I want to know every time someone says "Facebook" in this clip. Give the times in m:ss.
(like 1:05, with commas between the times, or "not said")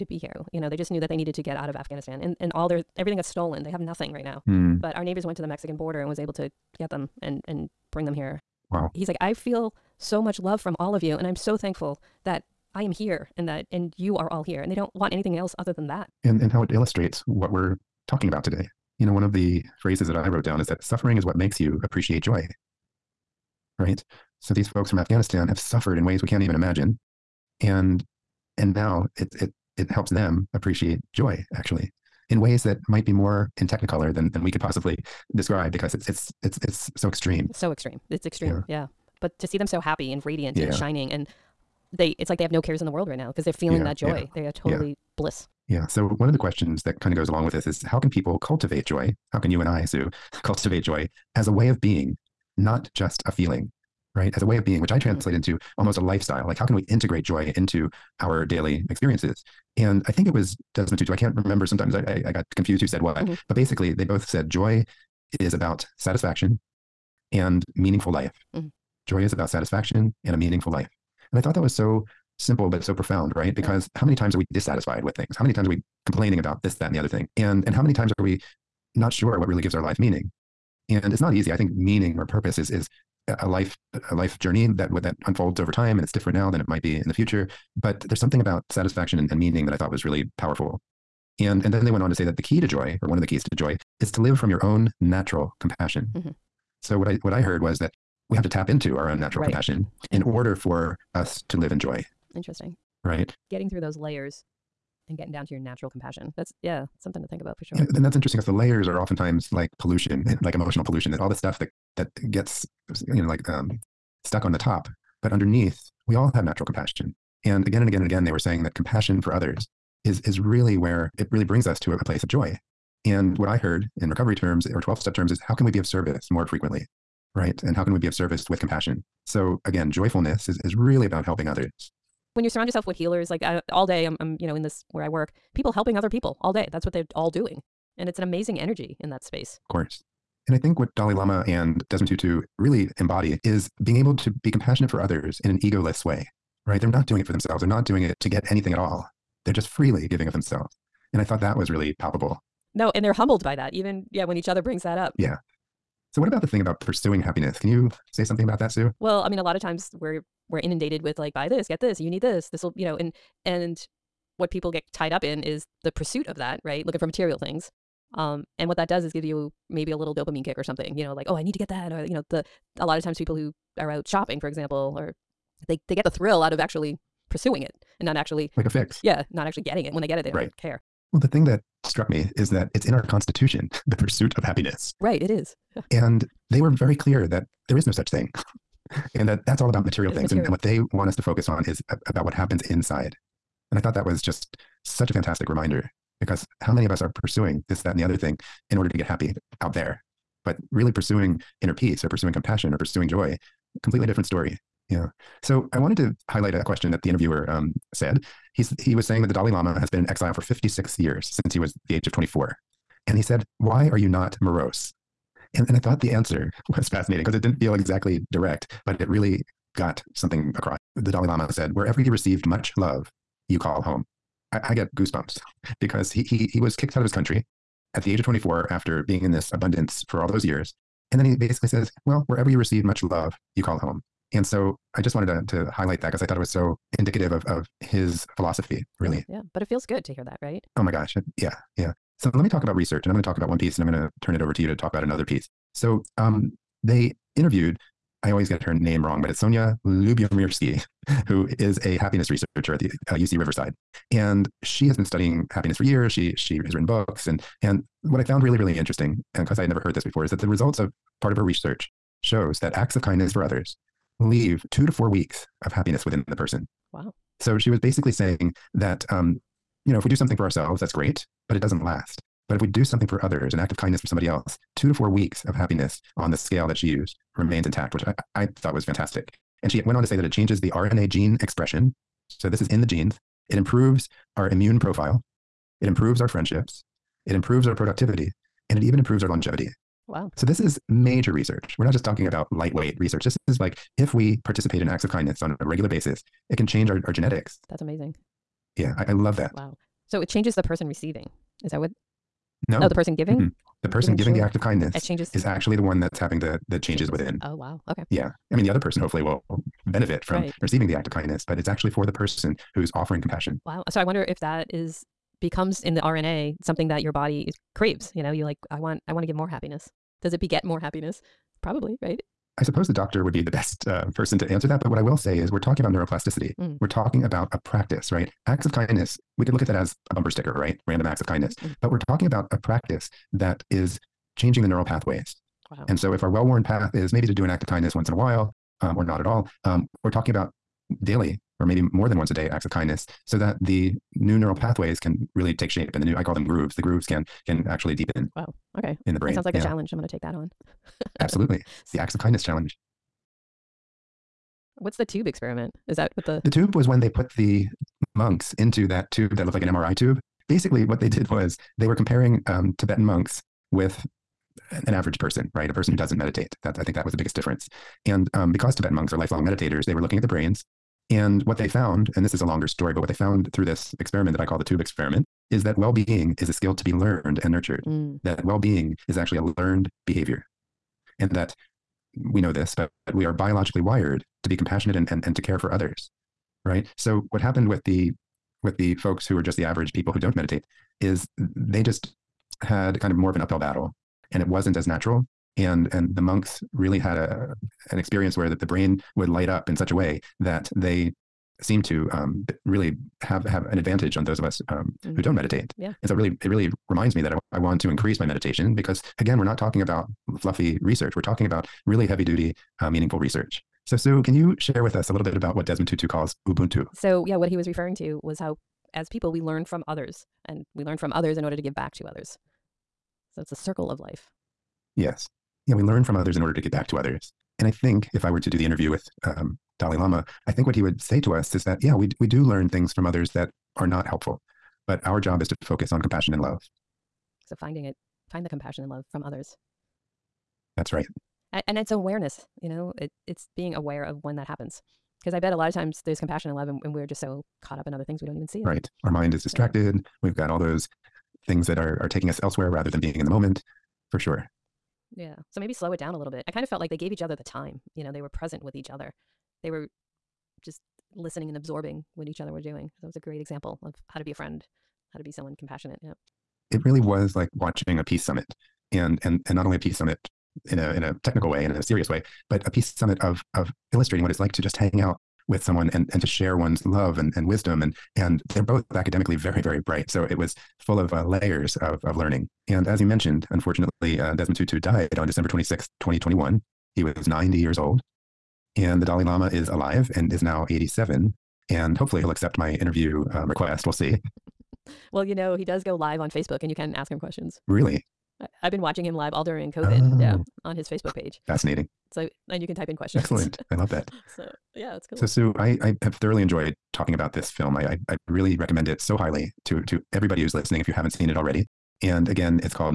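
8:16, 8:20.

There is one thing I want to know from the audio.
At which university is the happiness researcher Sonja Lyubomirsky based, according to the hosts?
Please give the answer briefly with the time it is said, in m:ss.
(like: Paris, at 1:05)
UC Riverside, at 4:13.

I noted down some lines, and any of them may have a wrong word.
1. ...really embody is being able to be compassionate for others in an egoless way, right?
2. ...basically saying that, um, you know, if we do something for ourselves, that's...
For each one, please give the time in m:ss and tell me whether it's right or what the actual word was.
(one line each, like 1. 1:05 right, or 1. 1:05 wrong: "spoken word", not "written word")
1. 2:22 right
2. 4:27 right.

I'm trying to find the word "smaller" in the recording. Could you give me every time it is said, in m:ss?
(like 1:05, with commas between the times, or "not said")
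not said.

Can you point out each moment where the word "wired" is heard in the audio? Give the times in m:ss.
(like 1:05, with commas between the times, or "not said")
6:23.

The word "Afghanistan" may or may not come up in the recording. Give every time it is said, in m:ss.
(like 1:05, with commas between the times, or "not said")
0:01, 0:24.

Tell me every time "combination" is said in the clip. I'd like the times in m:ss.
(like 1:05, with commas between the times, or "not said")
not said.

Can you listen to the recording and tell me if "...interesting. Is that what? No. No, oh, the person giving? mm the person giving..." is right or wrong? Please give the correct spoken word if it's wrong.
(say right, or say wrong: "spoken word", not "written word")
wrong: "receiving", not "interesting".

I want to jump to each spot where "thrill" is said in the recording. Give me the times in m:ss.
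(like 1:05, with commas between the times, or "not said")
2:56.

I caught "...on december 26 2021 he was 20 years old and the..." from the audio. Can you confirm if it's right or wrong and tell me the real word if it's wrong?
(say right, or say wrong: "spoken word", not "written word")
wrong: "90", not "20".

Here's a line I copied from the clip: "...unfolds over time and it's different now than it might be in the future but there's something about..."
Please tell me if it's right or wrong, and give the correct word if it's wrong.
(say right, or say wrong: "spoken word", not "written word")
right.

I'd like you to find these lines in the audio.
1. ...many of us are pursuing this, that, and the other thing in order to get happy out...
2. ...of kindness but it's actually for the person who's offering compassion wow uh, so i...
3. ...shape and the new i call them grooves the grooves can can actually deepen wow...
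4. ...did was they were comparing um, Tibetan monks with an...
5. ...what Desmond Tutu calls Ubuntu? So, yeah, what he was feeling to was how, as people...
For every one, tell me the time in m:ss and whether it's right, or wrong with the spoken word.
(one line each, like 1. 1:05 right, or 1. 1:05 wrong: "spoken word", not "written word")
1. 3:16 right
2. 5:11 right
3. 5:45 right
4. 6:01 right
5. 6:55 wrong: "referring", not "feeling".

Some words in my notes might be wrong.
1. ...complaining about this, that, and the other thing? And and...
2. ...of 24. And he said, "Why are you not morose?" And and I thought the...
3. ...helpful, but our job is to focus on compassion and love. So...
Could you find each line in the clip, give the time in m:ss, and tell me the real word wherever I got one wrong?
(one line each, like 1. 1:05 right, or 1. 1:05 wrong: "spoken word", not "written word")
1. 1:16 right
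2. 3:32 right
3. 7:14 right.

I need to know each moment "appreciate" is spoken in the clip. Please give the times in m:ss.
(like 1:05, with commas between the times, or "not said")
0:21, 0:30.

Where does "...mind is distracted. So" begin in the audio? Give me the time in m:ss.
7:29.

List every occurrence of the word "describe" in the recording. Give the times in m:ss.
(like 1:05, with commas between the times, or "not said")
0:35.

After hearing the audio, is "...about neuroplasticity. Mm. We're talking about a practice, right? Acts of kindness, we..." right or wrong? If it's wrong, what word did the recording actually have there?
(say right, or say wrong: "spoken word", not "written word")
right.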